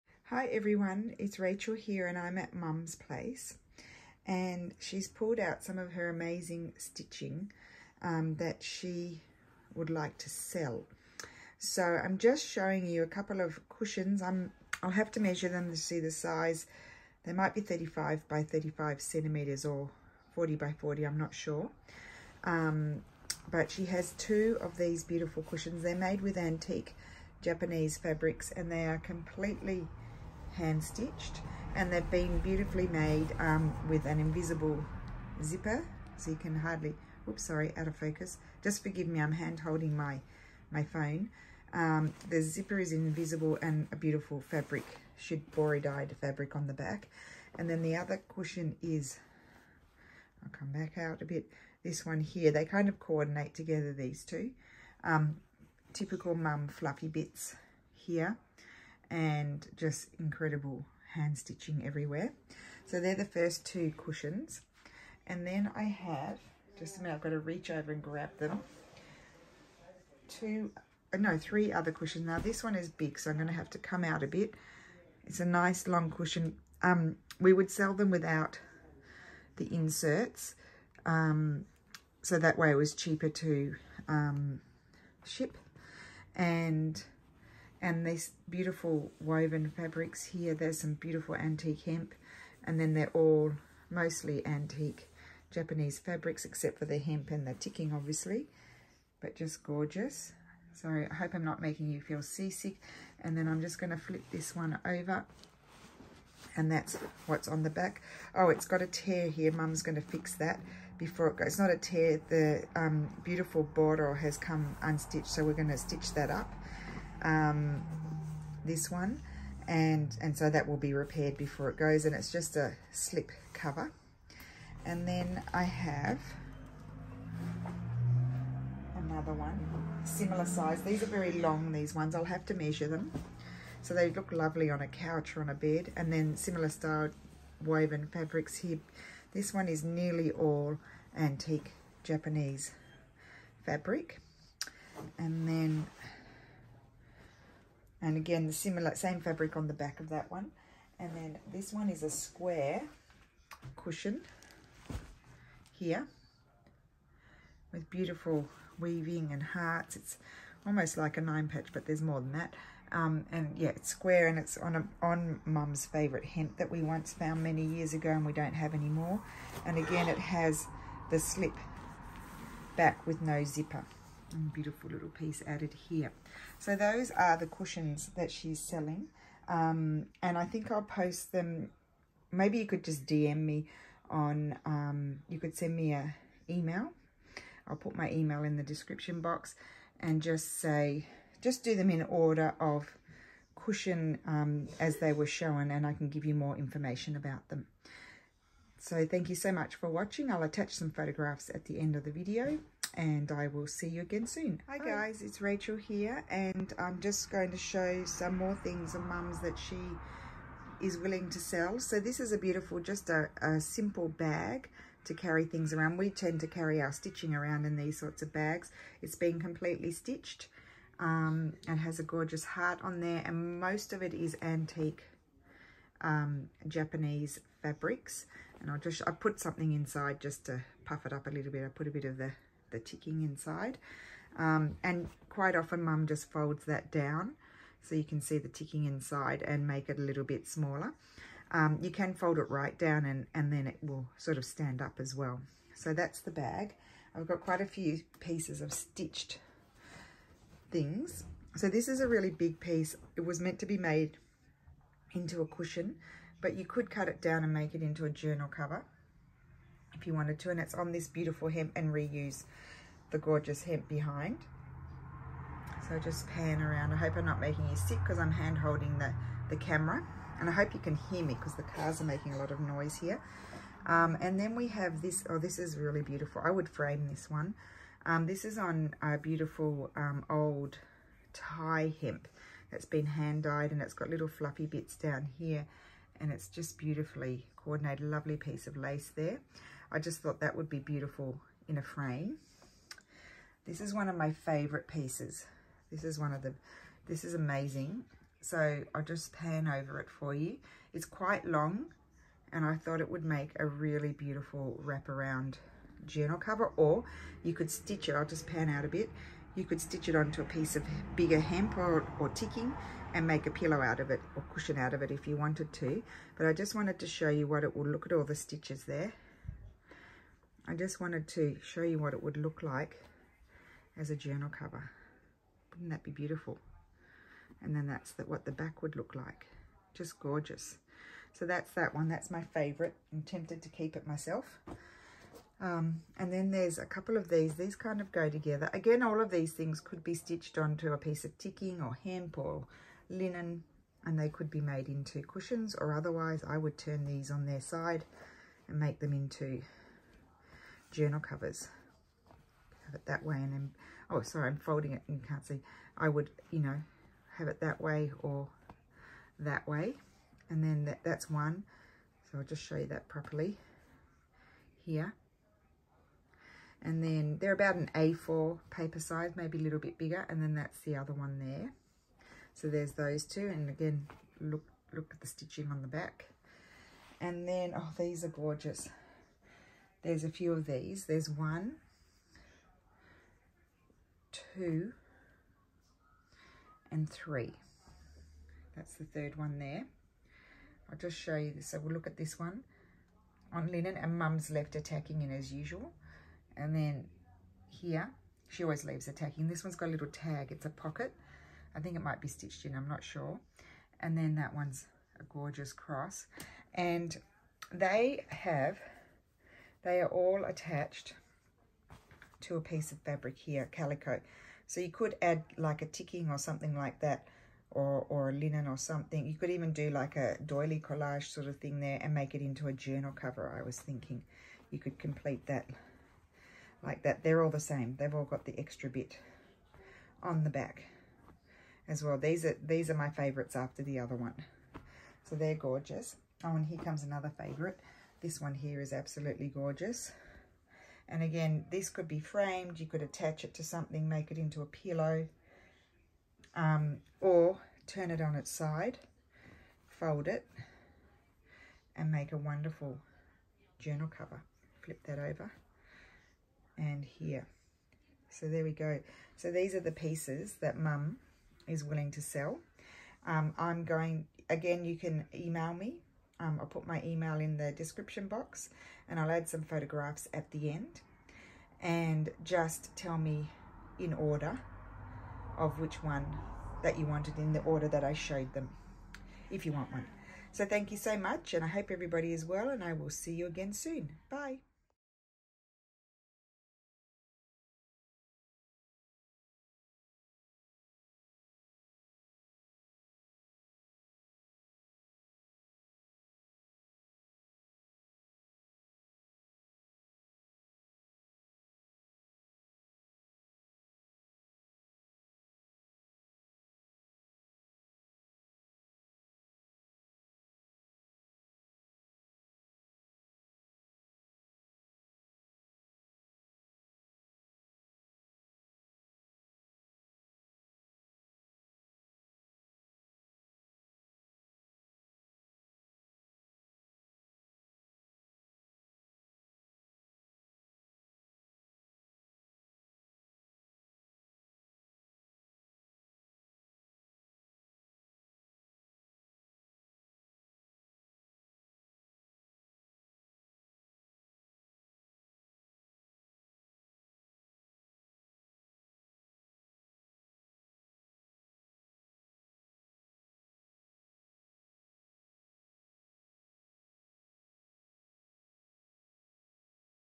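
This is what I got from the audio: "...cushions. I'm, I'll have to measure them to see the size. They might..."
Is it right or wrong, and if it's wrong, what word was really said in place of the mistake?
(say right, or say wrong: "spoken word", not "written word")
right.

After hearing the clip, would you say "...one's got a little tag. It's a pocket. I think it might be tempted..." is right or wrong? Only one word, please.
wrong.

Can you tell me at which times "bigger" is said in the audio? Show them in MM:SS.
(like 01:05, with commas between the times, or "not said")
05:11, 06:09.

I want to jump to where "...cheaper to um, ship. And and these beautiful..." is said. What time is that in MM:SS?
01:22.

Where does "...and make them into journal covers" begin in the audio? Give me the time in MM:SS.
05:48.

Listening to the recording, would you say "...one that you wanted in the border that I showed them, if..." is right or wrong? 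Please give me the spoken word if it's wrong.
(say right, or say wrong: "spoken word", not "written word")
wrong: "order", not "border".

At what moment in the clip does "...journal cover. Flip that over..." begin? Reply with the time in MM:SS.
07:33.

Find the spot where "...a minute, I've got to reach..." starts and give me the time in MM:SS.
01:06.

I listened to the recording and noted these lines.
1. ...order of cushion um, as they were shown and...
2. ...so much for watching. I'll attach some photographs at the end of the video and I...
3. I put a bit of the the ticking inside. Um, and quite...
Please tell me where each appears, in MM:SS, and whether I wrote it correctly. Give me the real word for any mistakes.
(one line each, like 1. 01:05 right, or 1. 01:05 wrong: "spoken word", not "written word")
1. 03:12 right
2. 03:19 right
3. 03:51 right.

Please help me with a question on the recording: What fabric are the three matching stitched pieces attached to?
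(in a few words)
Calico.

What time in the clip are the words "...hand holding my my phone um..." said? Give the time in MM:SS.
00:39.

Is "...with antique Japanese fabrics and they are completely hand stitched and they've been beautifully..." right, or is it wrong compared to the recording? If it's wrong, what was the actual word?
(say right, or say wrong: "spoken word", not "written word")
right.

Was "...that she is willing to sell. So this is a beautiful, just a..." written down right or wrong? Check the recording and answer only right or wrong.
right.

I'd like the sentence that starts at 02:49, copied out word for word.
And again, it has the slip back with no zipper.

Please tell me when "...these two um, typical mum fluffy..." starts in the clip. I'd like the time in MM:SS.
00:53.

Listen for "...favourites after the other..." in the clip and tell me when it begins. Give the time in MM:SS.
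07:13.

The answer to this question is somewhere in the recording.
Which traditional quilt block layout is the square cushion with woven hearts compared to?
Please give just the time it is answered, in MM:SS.
02:41.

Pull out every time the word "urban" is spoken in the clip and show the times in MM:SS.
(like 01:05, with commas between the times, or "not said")
not said.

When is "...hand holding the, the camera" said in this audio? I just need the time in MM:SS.
04:28.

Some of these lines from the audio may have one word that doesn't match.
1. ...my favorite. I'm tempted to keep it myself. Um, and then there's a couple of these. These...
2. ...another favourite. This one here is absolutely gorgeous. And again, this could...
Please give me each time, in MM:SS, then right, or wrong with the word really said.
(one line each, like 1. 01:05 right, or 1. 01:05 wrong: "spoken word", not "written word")
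1. 05:32 right
2. 07:17 right.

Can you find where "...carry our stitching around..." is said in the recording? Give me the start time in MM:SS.
03:36.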